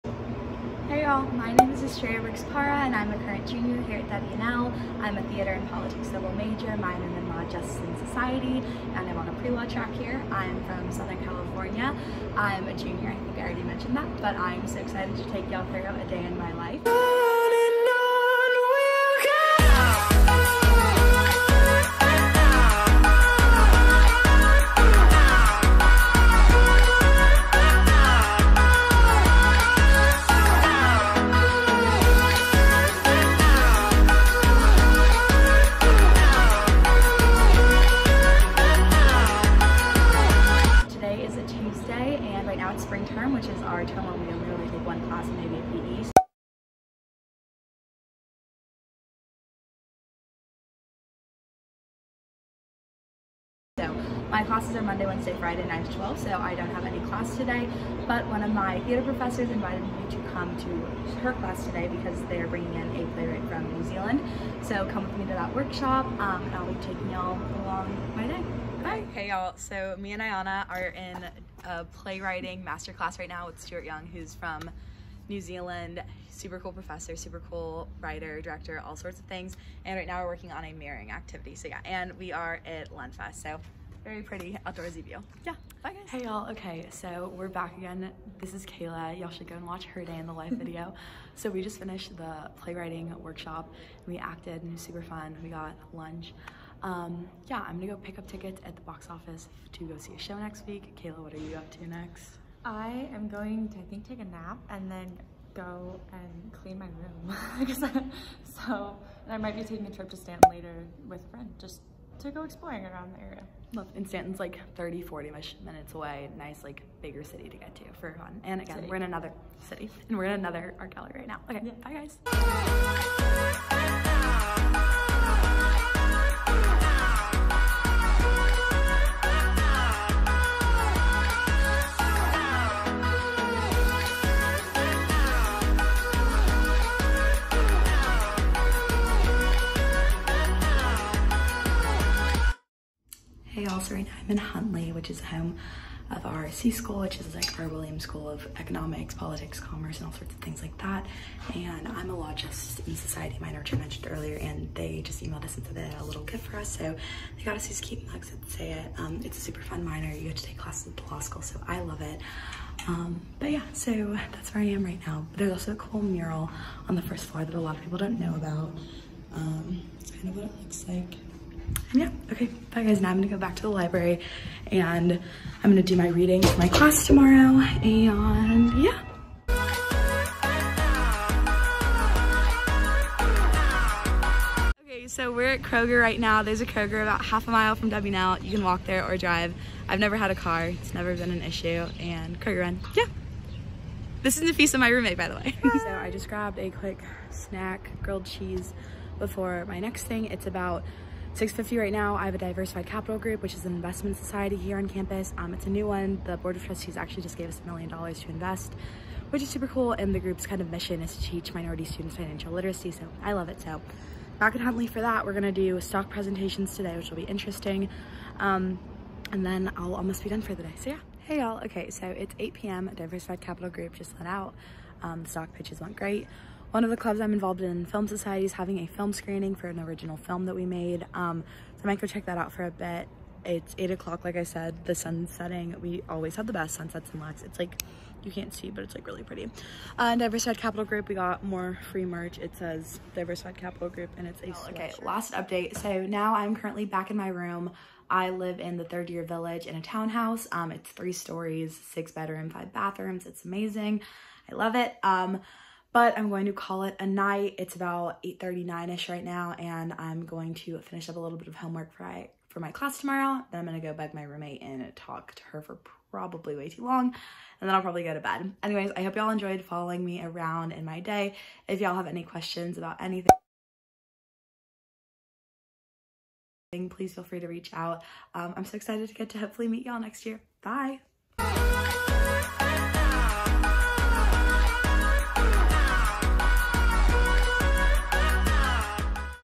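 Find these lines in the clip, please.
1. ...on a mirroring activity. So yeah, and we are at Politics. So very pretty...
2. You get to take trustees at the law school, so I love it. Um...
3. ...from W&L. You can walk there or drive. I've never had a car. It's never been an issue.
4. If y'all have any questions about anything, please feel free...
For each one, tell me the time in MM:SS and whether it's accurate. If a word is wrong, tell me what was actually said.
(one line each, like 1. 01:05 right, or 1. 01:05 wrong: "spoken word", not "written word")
1. 01:20 wrong: "Lenfest", not "Politics"
2. 02:40 wrong: "classes", not "trustees"
3. 03:07 right
4. 04:31 right.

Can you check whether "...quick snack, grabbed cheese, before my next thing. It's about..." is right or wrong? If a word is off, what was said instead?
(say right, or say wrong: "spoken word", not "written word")
wrong: "grilled", not "grabbed".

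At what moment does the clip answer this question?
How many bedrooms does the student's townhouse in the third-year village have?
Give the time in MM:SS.
04:11.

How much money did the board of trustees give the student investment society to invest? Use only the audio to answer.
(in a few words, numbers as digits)
$1 million.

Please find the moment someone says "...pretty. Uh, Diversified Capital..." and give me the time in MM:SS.
03:59.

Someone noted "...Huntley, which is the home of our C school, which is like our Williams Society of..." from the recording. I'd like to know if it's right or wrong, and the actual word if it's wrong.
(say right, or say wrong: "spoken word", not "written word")
wrong: "School", not "Society".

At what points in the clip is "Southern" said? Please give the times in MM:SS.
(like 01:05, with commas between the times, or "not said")
00:10.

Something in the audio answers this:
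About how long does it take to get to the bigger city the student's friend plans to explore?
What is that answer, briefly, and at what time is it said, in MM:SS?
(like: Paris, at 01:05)
30 to 40 minutes, at 01:54.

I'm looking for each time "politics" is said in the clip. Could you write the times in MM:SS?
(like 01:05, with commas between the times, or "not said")
00:05, 02:29.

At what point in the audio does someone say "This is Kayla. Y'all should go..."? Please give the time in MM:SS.
01:28.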